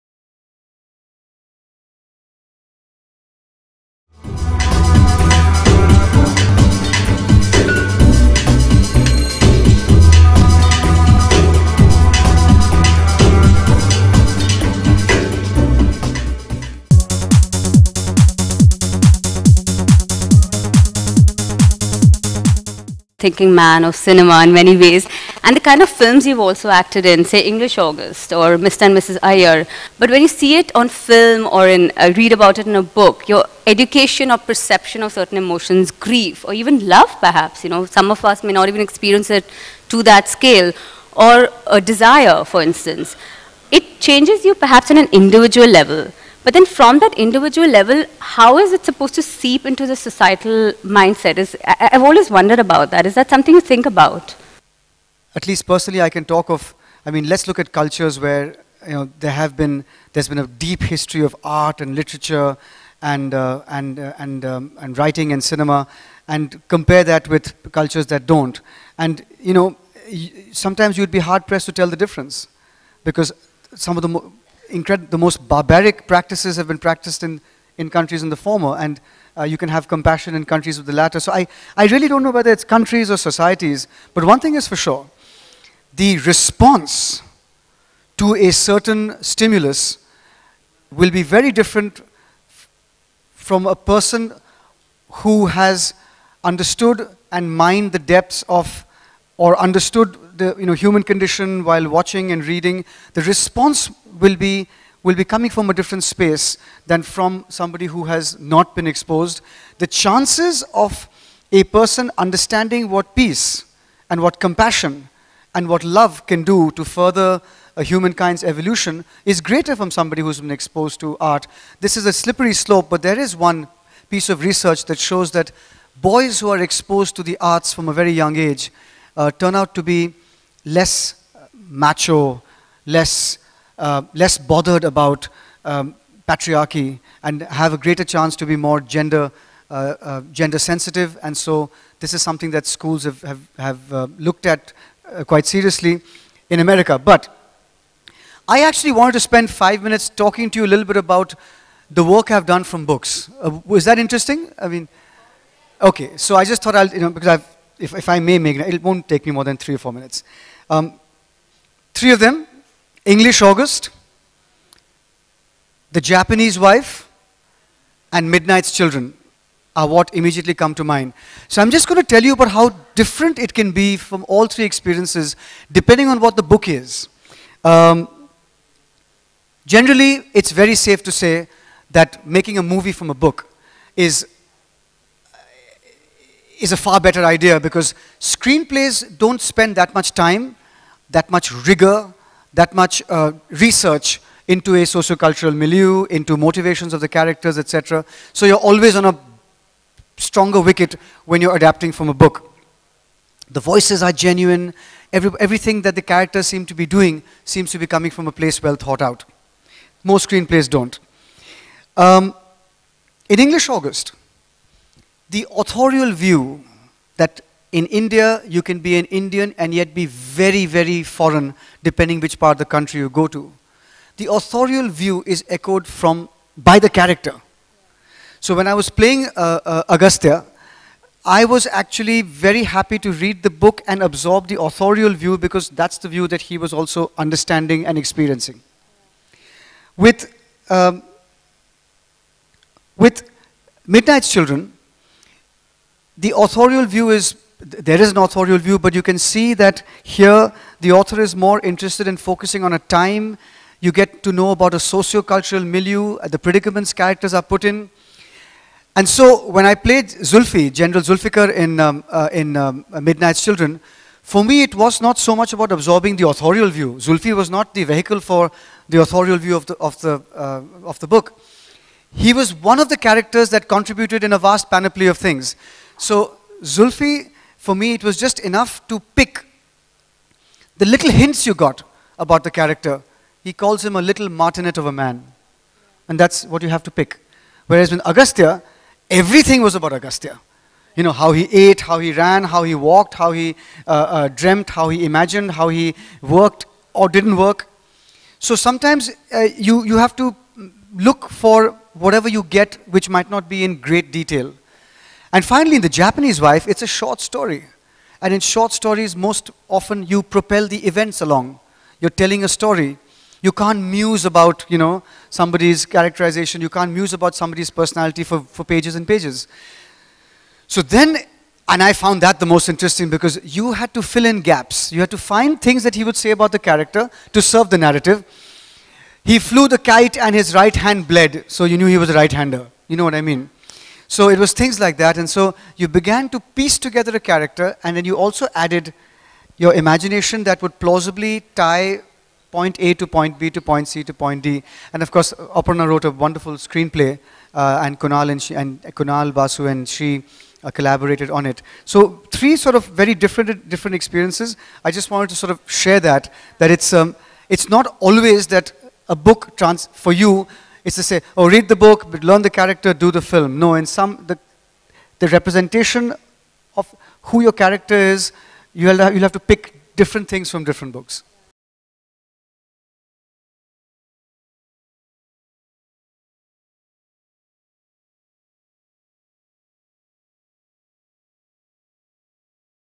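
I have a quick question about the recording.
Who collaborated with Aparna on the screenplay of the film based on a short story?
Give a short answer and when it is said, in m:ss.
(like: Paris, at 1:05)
Kunal Basu, at 5:48.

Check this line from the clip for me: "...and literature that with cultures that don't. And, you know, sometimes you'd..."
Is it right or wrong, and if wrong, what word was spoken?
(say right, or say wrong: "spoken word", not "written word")
wrong: "compare", not "literature".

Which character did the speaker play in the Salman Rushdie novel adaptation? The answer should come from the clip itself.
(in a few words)
General Zulfikar.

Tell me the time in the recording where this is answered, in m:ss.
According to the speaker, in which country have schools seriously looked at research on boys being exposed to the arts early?
2:26.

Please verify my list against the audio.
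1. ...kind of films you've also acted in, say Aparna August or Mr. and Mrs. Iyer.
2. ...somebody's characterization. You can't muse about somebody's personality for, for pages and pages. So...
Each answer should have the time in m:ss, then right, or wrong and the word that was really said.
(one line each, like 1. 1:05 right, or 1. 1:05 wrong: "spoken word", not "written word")
1. 0:25 wrong: "English", not "Aparna"
2. 5:15 right.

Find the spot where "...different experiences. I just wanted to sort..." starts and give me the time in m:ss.
5:53.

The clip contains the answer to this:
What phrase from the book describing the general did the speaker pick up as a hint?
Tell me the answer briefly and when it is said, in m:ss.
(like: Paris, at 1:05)
little martinet of a man, at 4:44.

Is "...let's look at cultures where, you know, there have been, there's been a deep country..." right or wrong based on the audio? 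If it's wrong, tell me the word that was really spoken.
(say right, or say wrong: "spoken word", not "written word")
wrong: "history", not "country".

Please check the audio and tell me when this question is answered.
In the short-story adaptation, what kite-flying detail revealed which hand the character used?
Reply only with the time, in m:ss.
5:30.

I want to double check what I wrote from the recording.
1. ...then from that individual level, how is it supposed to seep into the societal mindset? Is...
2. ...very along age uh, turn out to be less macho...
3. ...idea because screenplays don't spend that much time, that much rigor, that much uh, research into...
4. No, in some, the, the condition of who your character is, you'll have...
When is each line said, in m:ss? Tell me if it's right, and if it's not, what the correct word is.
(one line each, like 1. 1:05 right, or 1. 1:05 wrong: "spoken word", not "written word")
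1. 0:46 right
2. 2:07 wrong: "young", not "along"
3. 3:07 right
4. 6:03 wrong: "representation", not "condition".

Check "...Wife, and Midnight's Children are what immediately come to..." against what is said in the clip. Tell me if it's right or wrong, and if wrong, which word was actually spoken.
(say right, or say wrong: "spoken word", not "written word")
right.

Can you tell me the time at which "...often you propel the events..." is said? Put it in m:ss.
5:09.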